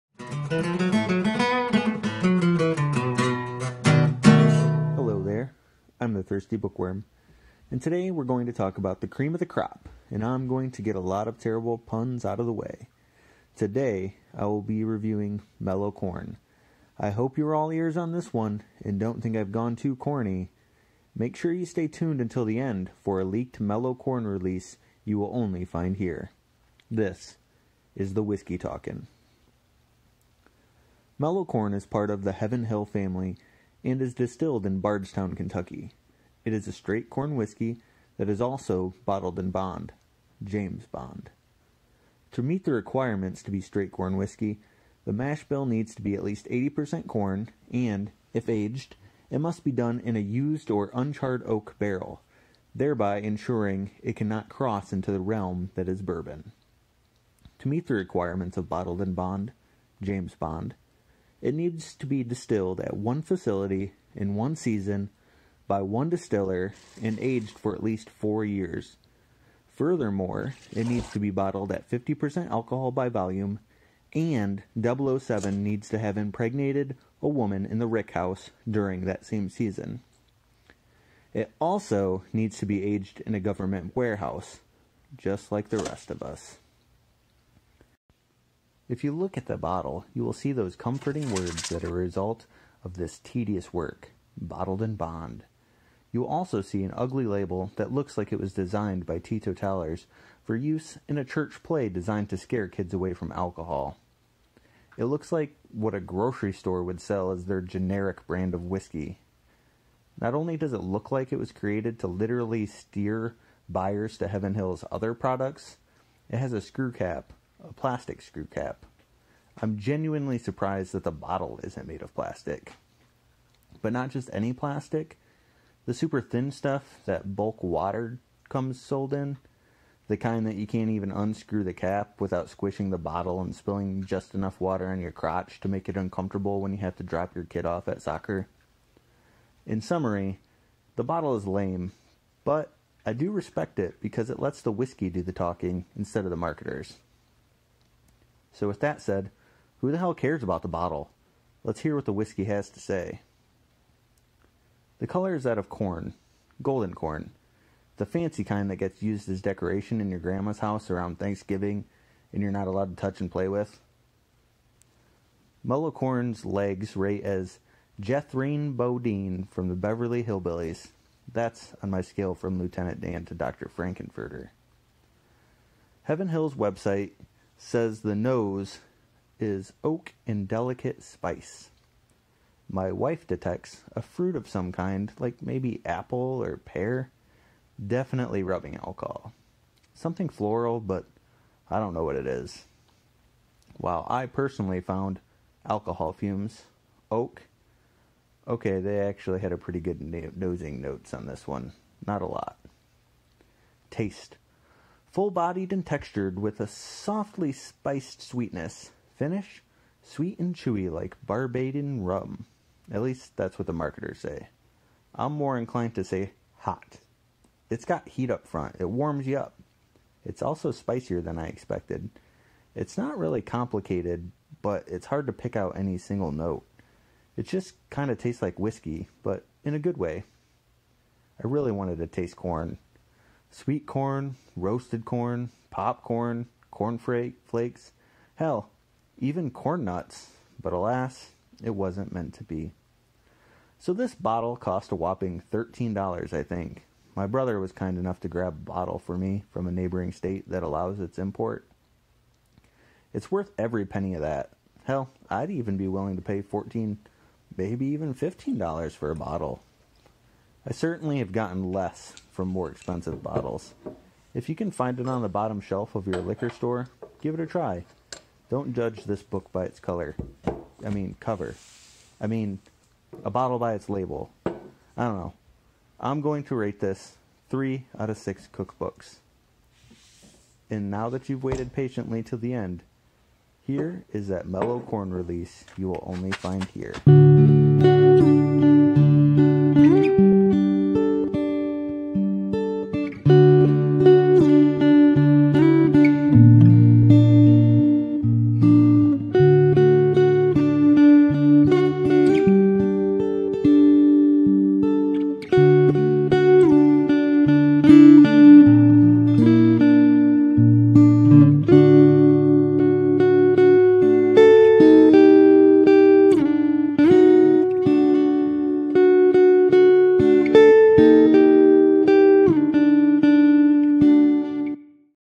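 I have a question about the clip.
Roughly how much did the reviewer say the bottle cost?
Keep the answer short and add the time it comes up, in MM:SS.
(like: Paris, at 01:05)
$13, at 04:05.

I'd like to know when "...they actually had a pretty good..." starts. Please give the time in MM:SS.
03:18.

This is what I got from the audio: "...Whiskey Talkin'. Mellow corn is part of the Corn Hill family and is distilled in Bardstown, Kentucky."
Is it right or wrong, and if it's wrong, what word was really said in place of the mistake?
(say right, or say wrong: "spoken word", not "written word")
wrong: "Heaven", not "Corn".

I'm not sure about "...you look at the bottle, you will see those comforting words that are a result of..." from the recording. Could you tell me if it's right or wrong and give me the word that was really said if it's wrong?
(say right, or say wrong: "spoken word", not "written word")
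right.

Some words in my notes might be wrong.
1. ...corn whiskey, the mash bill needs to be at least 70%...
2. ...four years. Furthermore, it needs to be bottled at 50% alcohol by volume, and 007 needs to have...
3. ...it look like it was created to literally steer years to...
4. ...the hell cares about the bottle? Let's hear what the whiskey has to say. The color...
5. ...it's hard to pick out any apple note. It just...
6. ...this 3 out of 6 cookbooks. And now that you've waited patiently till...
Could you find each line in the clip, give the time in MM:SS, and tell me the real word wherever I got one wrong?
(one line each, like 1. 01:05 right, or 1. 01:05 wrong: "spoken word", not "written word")
1. 00:43 wrong: "80", not "70"
2. 01:08 right
3. 01:50 wrong: "buyers", not "years"
4. 02:29 right
5. 03:44 wrong: "single", not "apple"
6. 04:36 right.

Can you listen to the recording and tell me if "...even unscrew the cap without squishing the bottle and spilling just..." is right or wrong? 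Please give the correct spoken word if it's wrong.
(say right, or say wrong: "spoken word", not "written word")
right.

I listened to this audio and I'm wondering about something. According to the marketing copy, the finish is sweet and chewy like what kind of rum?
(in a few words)
Barbadian rum.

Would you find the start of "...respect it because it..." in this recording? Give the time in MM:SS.
02:23.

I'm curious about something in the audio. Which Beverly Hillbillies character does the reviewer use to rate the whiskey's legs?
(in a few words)
Jethrine Bodine.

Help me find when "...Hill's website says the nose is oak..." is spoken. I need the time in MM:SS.
02:56.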